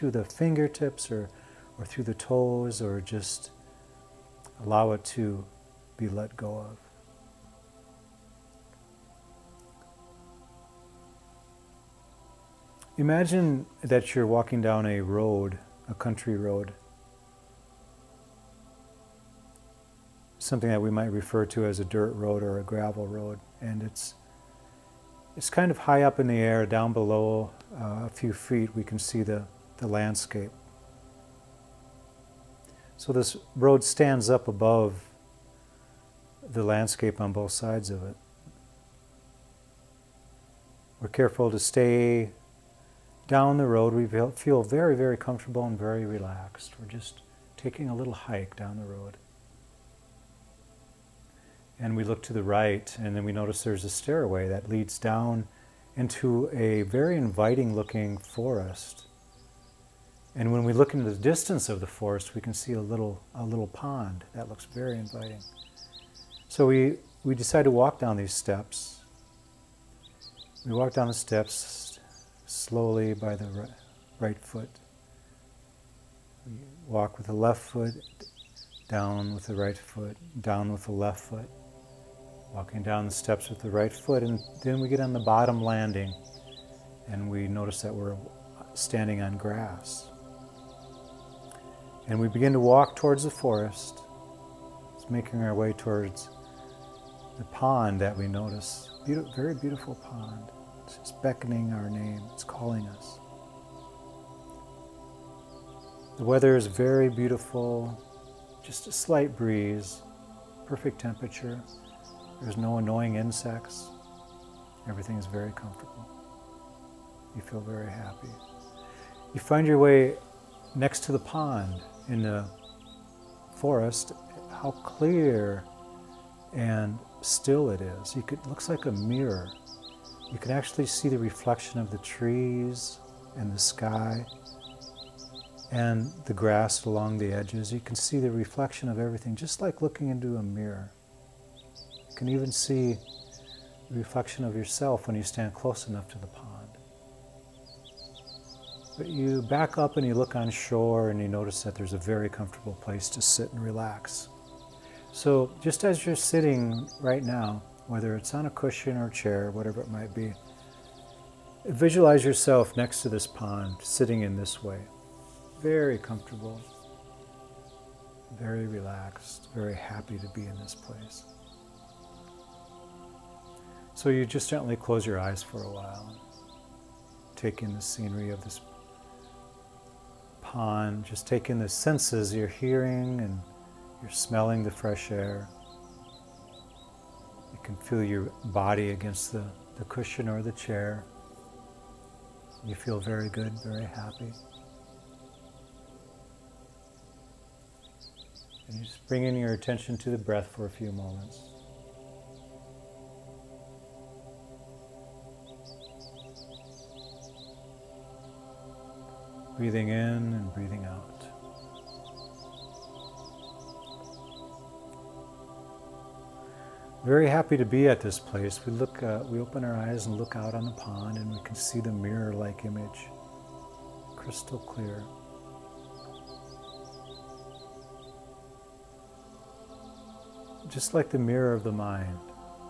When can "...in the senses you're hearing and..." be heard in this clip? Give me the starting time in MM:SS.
03:01.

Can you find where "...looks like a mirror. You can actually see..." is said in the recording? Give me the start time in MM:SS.
02:08.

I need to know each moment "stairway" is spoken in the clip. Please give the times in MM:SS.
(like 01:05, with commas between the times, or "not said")
00:53.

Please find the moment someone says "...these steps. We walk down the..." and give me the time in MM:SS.
01:08.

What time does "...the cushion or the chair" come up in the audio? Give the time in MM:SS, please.
03:09.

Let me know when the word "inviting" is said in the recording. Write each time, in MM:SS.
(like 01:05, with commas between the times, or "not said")
00:57, 01:04.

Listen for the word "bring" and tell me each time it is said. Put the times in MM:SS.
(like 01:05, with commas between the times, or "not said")
03:19.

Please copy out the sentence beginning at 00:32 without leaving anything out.
So this road stands up above the landscape on both sides of it.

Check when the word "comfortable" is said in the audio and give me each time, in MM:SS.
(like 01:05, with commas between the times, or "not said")
00:45, 01:55, 02:32, 02:45.